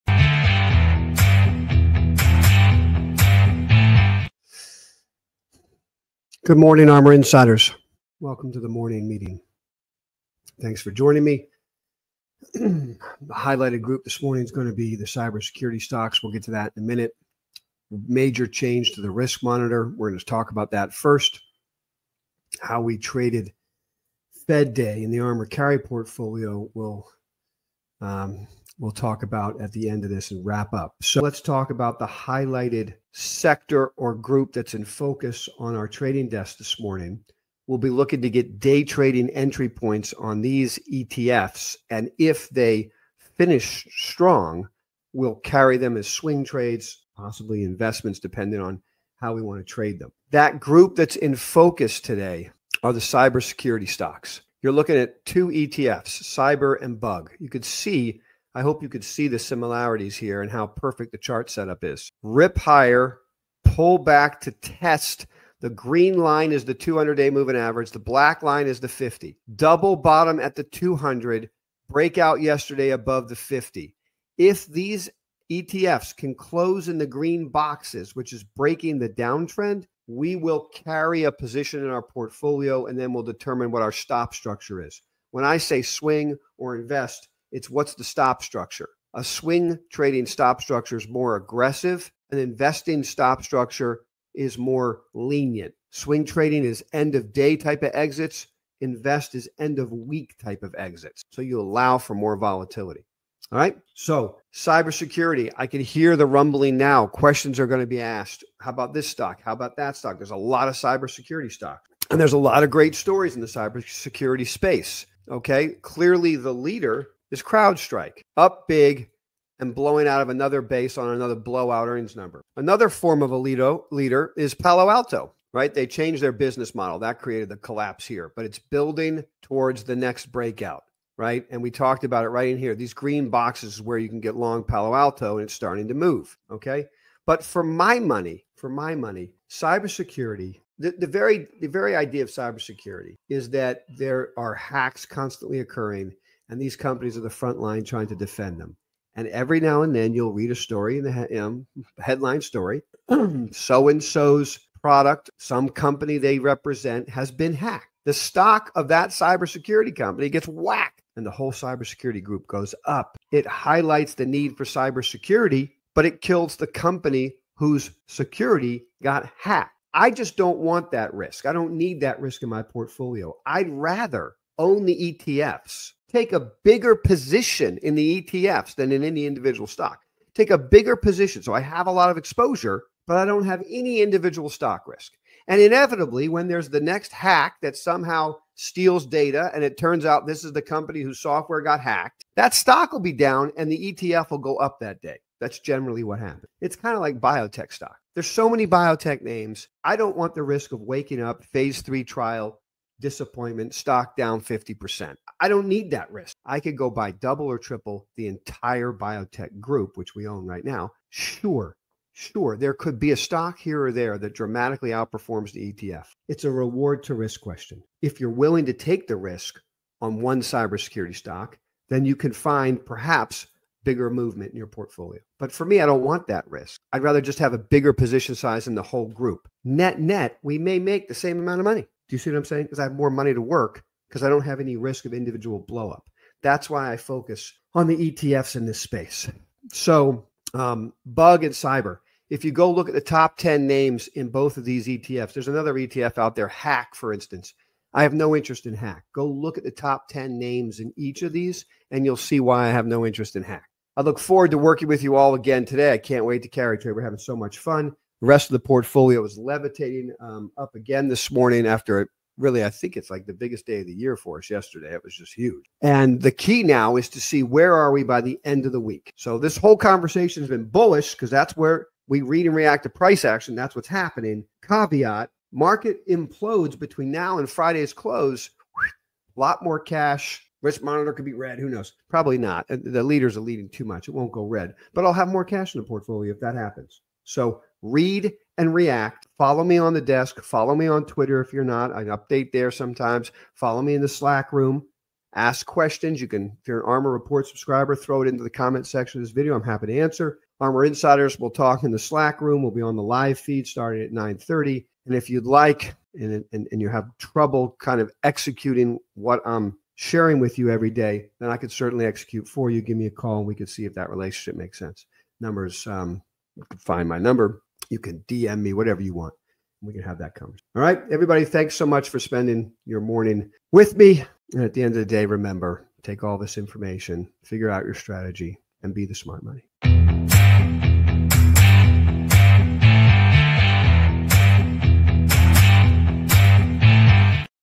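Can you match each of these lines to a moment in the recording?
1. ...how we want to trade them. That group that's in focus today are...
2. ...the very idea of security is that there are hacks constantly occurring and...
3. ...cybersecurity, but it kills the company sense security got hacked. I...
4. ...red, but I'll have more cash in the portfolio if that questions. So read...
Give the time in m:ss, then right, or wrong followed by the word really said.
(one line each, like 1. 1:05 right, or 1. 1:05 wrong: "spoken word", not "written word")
1. 0:49 right
2. 2:21 wrong: "cybersecurity", not "security"
3. 2:44 wrong: "whose", not "sense"
4. 4:44 wrong: "happens", not "questions".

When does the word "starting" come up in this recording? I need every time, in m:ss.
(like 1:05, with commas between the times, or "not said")
2:15, 5:03.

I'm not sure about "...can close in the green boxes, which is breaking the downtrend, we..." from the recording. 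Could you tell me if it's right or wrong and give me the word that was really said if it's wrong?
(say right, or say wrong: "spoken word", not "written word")
right.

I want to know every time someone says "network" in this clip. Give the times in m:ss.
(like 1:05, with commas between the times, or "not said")
not said.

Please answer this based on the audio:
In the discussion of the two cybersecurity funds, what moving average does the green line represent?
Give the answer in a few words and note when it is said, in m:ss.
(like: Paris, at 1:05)
200 day moving average, at 1:06.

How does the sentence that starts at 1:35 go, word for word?
Swing trading is end of day type of exits.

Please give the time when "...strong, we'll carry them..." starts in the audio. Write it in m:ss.
0:43.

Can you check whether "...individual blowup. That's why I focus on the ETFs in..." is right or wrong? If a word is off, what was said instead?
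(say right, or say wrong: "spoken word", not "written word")
right.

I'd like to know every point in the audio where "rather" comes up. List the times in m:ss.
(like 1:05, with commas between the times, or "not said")
2:53, 3:47.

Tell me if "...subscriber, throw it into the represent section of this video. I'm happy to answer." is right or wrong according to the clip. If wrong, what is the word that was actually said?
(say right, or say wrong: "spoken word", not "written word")
wrong: "comment", not "represent".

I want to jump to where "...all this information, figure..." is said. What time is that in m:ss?
5:26.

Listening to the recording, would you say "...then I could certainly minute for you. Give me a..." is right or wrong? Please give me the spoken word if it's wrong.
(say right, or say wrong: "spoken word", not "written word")
wrong: "execute", not "minute".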